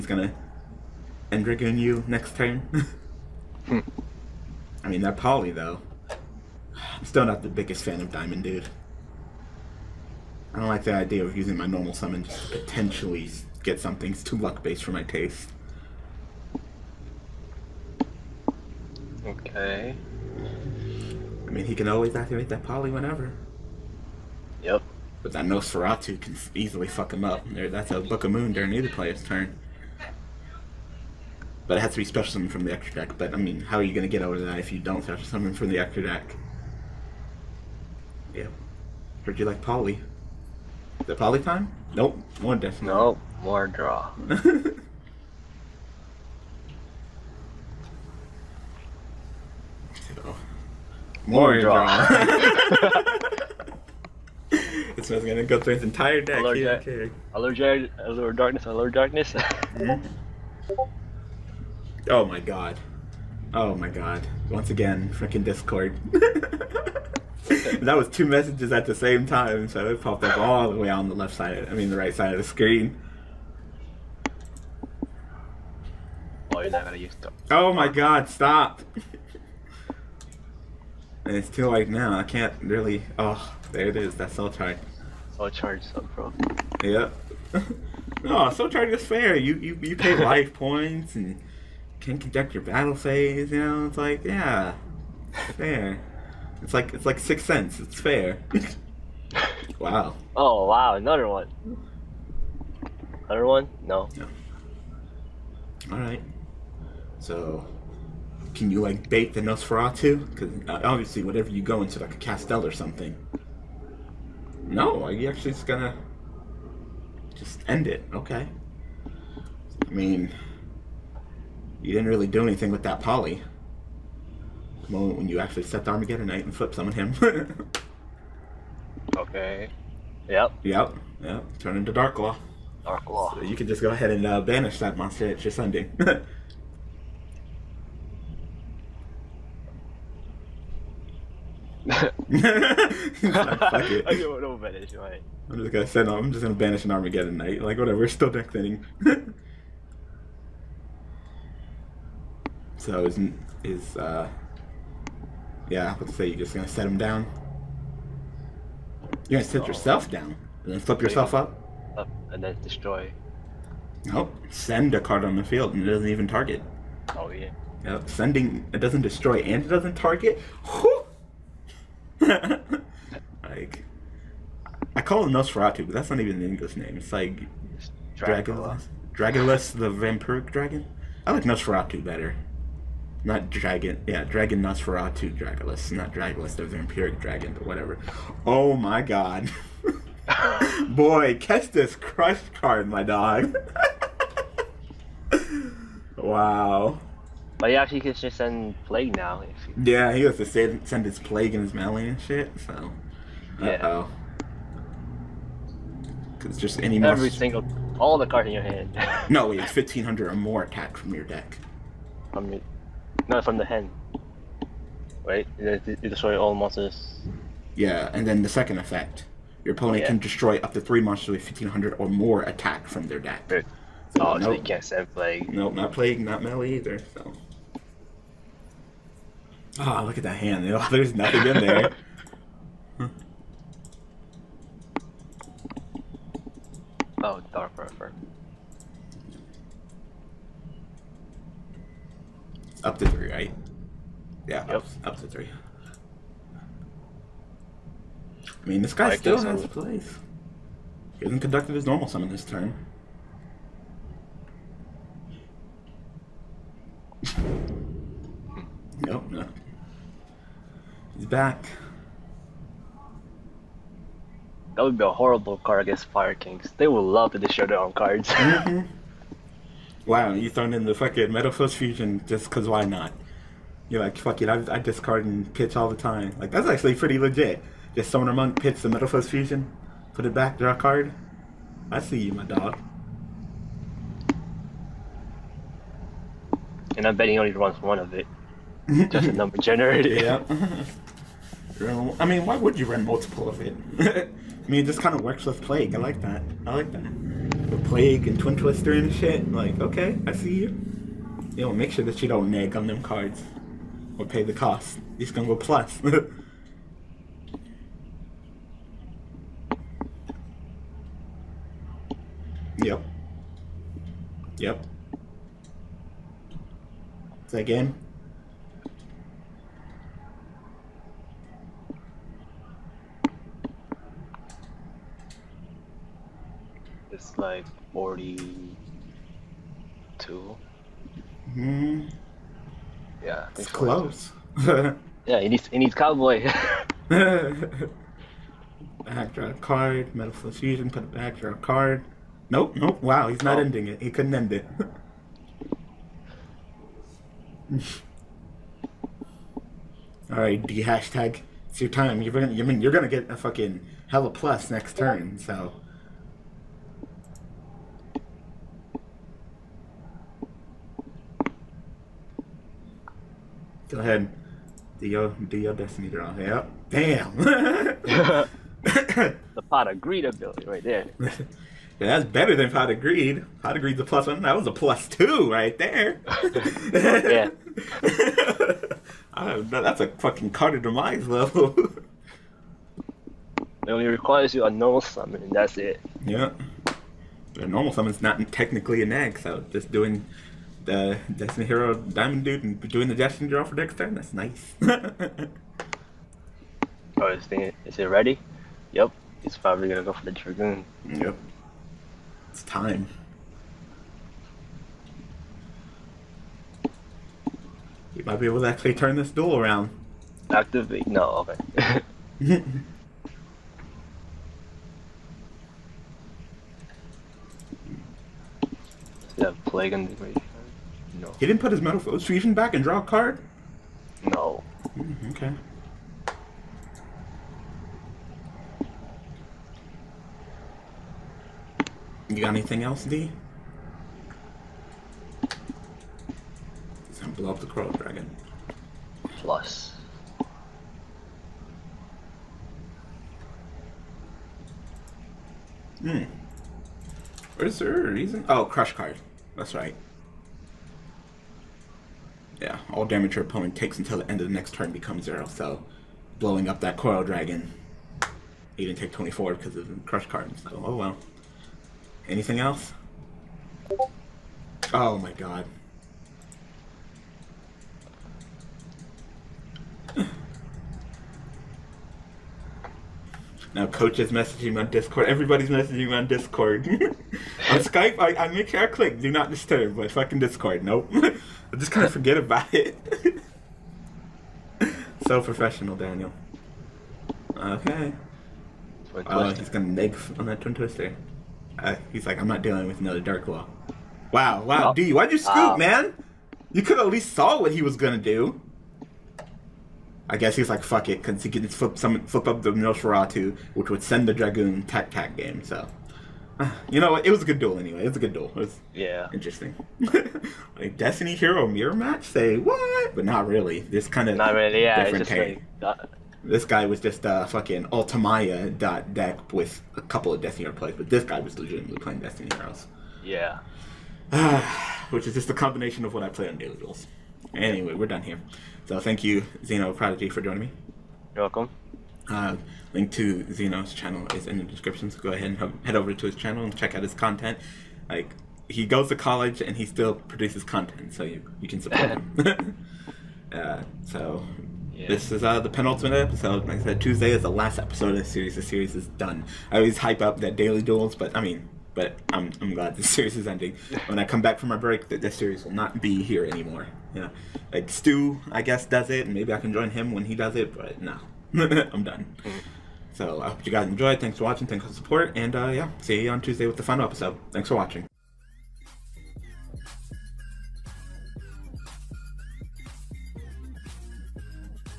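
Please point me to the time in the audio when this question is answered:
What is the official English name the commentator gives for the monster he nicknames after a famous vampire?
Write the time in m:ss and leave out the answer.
2:59.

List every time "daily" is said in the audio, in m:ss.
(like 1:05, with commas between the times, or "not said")
8:46, 9:10.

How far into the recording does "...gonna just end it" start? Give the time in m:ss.
1:55.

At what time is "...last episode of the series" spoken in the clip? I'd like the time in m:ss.
9:07.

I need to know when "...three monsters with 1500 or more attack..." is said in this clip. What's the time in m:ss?
3:40.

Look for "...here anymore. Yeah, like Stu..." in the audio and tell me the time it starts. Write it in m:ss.
9:16.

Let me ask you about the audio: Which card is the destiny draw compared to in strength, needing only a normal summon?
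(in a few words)
Card of Demise.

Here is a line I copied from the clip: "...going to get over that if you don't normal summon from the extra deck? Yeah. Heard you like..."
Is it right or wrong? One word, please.
wrong.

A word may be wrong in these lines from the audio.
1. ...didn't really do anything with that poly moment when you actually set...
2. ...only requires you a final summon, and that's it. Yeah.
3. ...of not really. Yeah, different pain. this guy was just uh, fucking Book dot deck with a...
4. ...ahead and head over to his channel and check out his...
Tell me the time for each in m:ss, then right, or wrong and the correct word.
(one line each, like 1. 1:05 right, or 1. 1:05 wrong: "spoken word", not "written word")
1. 2:01 right
2. 6:23 wrong: "normal", not "final"
3. 8:34 wrong: "Ultimaya", not "Book"
4. 8:55 right.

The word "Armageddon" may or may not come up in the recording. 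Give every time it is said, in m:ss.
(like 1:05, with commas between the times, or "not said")
2:05, 2:26.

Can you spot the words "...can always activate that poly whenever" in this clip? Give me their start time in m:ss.
0:21.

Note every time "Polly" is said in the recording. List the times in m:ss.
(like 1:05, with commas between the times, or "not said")
0:05, 0:39.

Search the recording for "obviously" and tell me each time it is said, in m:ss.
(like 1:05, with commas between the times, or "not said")
1:50.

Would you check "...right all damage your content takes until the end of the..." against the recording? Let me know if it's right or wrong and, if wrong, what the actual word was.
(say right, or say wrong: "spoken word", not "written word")
wrong: "opponent", not "content".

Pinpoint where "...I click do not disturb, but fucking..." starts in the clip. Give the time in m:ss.
7:58.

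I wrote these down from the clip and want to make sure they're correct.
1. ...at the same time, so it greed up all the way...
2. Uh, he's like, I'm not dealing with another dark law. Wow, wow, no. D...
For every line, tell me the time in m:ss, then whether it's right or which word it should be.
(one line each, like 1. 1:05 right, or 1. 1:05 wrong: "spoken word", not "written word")
1. 1:08 wrong: "popped", not "greed"
2. 8:11 right.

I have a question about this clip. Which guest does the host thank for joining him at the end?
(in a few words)
Xeno Prodigy.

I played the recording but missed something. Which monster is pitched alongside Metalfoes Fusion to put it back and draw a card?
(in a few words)
Summoner Monk.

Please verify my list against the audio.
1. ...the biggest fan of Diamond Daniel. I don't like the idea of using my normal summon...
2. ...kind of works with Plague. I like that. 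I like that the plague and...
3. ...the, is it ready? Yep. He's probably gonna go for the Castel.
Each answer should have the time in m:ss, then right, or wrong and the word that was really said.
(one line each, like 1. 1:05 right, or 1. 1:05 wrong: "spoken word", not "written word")
1. 0:07 wrong: "Dude", not "Daniel"
2. 4:55 right
3. 6:37 wrong: "Dragoon", not "Castel".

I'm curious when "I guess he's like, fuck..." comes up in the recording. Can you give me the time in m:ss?
8:20.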